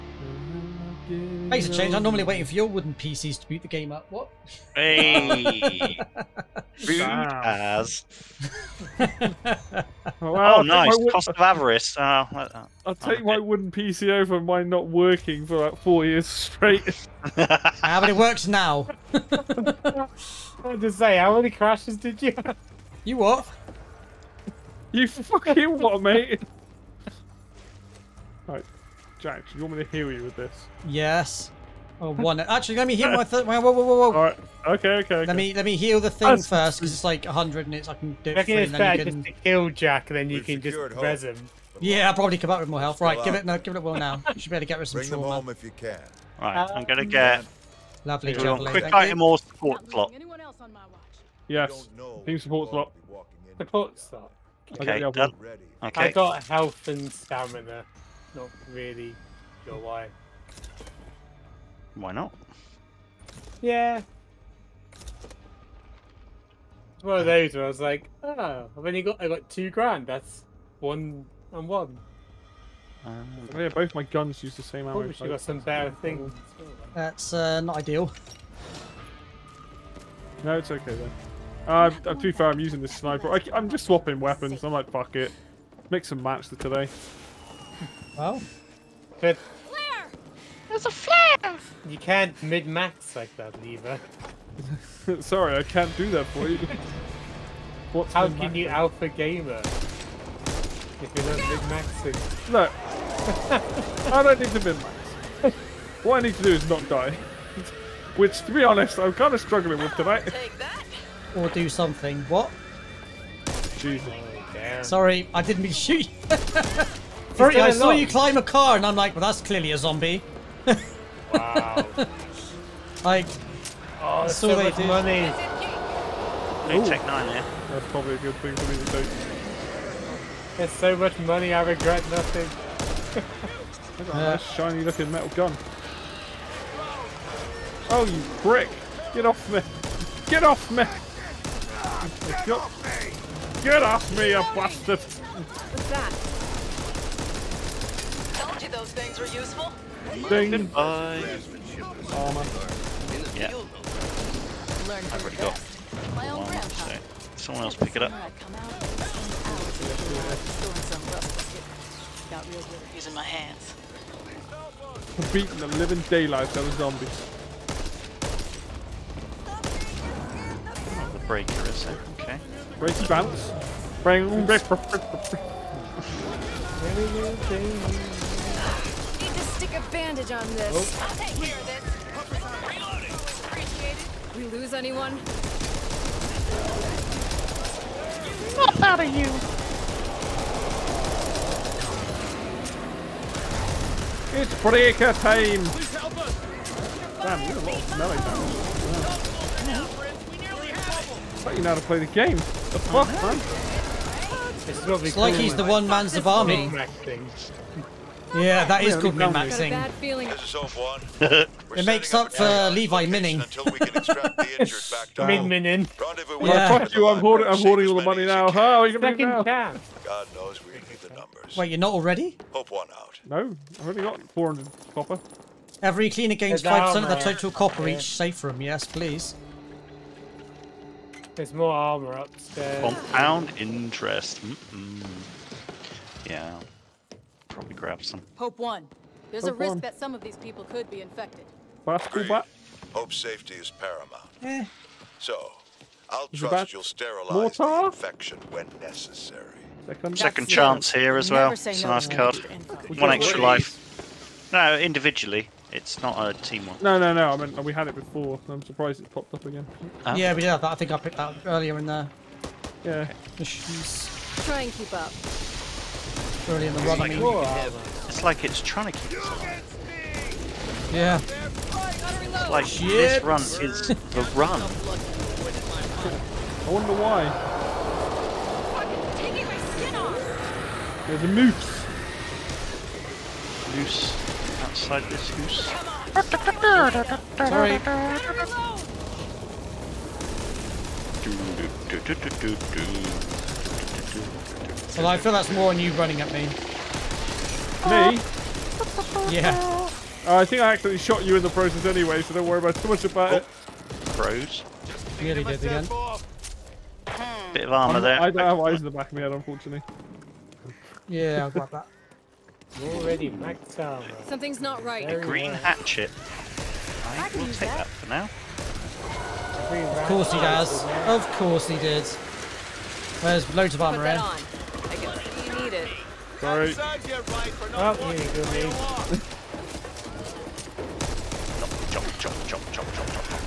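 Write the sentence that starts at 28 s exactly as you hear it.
Right, Jack, you want me to heal you with this?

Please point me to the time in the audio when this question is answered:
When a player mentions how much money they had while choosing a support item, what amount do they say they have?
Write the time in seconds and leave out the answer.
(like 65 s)
69 s.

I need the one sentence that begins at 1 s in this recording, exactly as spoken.
I'm normally waiting for your wooden PCs to boot the game up.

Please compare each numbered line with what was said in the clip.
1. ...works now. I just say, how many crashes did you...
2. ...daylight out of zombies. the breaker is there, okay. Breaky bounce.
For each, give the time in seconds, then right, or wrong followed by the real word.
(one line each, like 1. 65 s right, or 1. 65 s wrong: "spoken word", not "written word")
1. 18 s right
2. 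166 s right.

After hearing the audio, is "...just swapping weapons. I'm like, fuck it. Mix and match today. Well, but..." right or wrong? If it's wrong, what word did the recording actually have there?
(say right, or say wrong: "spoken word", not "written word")
right.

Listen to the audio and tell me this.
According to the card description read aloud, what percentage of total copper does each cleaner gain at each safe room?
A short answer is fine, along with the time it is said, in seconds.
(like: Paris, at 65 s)
5%, at 226 s.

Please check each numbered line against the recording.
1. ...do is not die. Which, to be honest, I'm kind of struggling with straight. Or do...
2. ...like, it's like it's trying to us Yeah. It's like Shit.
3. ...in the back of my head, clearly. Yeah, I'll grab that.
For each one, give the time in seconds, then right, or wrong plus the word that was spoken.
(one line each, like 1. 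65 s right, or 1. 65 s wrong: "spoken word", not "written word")
1. 106 s wrong: "tonight", not "straight"
2. 268 s right
3. 308 s wrong: "unfortunately", not "clearly".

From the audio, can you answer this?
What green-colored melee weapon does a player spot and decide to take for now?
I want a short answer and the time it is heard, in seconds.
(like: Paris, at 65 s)
hatchet, at 315 s.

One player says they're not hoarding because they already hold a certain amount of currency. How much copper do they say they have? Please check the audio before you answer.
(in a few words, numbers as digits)
400.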